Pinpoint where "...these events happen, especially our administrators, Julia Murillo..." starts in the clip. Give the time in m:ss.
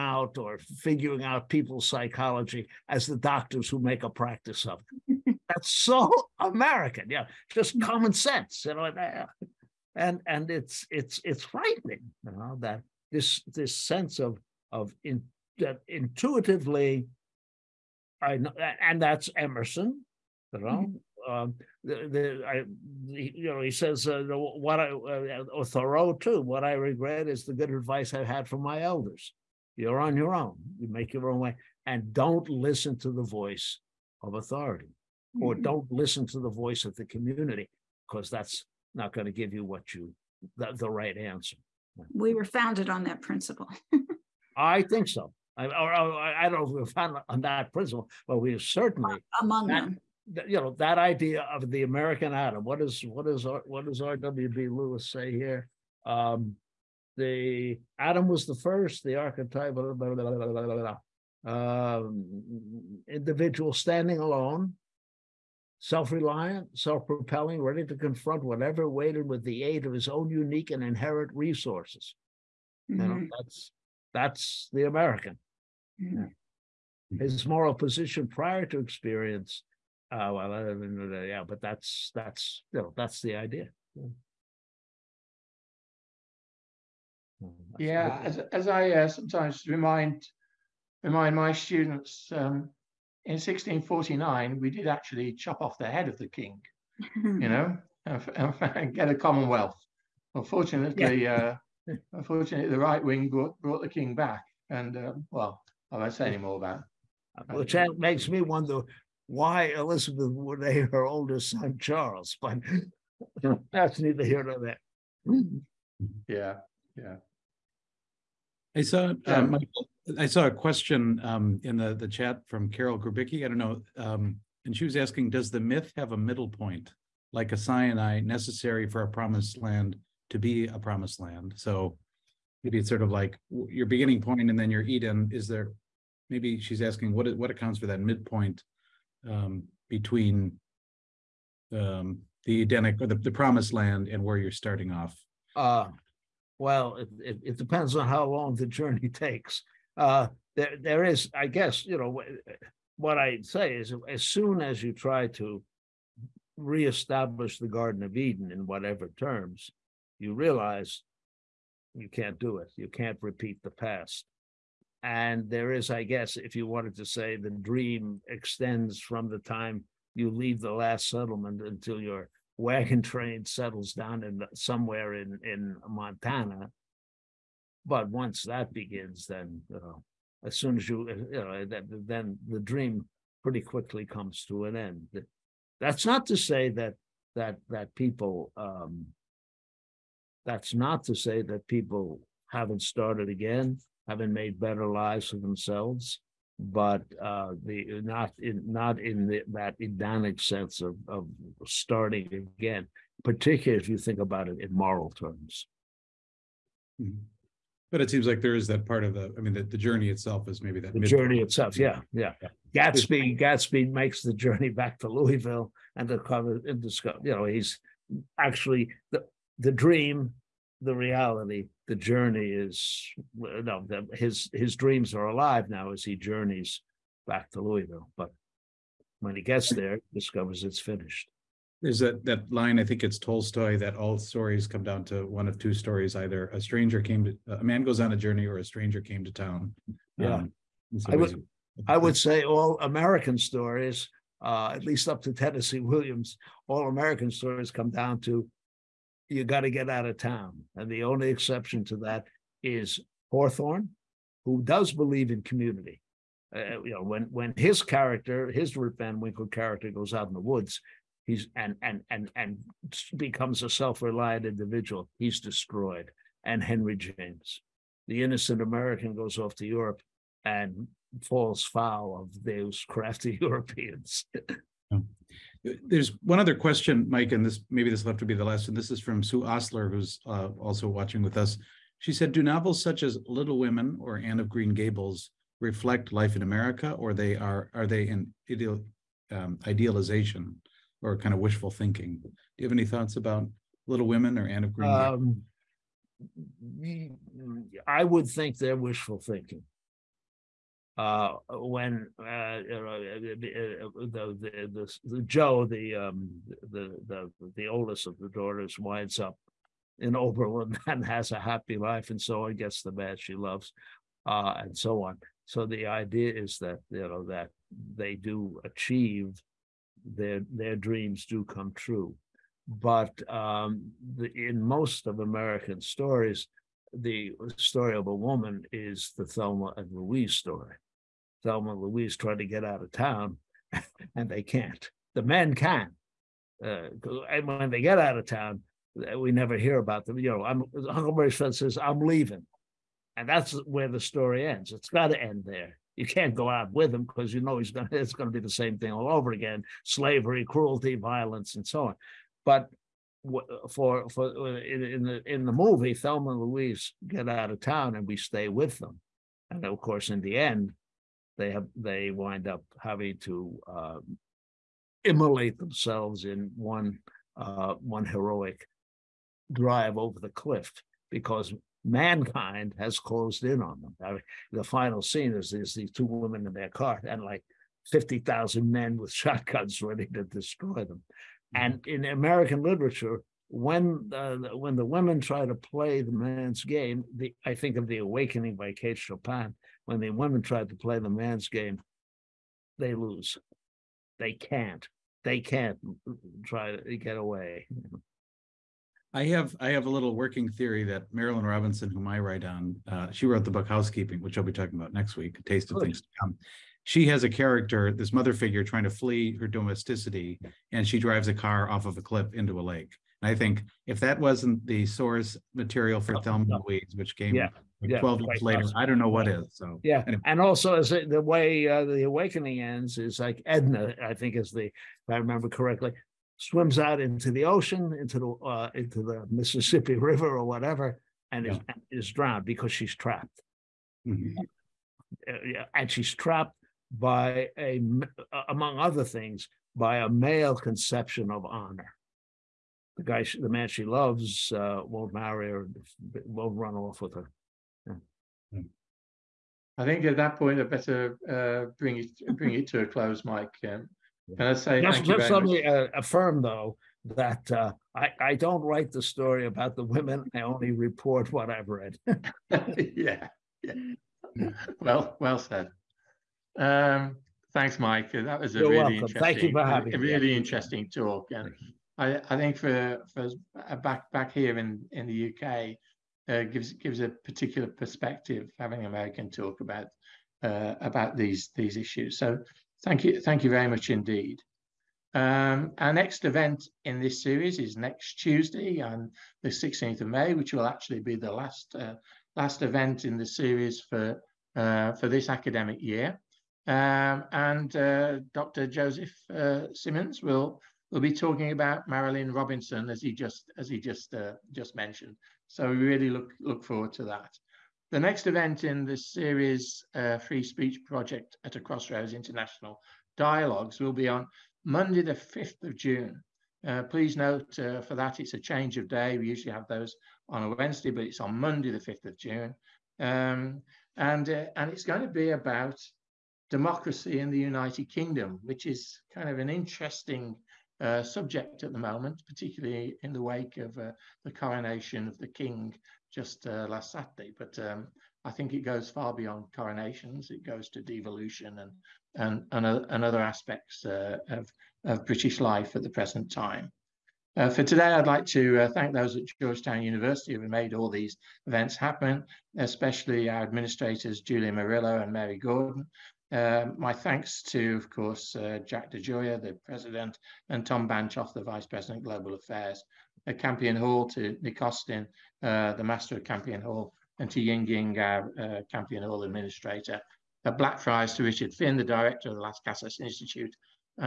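9:10.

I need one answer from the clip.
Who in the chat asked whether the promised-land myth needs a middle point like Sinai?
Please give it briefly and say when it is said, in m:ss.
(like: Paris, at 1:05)
Carol Grubicki, at 2:02.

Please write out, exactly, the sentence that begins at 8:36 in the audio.
Uh, please note uh, for that it's a change of day.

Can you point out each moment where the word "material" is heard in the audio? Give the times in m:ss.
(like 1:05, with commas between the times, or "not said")
6:55.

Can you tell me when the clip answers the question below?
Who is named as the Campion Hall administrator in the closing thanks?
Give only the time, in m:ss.
9:27.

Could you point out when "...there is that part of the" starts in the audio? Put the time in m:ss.
3:28.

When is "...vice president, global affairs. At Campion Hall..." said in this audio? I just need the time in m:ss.
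9:21.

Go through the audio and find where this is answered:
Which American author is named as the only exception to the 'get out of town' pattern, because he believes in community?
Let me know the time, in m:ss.
4:13.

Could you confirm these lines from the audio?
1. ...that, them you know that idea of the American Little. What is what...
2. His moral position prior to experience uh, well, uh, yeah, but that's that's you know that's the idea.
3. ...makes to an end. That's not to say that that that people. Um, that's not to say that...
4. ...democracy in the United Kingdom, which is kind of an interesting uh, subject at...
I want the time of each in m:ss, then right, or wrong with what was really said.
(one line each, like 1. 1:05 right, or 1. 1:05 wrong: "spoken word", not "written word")
1. 0:49 wrong: "Adam", not "Little"
2. 1:17 right
3. 3:04 wrong: "comes", not "makes"
4. 8:46 right.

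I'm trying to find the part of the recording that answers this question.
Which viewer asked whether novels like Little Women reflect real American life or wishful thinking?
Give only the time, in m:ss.
4:39.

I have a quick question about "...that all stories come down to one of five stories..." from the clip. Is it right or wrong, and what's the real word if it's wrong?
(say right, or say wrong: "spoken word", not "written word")
wrong: "two", not "five".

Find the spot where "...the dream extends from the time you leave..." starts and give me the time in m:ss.
2:47.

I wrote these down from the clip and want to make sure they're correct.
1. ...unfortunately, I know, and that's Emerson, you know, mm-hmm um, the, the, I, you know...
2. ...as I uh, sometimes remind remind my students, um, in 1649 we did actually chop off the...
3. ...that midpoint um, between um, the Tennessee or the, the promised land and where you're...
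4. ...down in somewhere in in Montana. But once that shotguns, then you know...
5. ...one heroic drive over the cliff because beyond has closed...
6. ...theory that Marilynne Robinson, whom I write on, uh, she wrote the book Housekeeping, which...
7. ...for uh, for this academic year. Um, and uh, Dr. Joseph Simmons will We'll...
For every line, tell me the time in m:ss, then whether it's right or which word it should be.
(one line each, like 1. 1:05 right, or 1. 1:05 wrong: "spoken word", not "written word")
1. 0:15 wrong: "intuitively", not "unfortunately"
2. 1:28 right
3. 2:17 wrong: "Edenic", not "Tennessee"
4. 2:53 wrong: "begins", not "shotguns"
5. 6:07 wrong: "mankind", not "beyond"
6. 6:40 right
7. 8:13 right.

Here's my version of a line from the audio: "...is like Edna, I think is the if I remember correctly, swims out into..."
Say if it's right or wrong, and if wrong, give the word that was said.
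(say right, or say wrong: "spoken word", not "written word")
right.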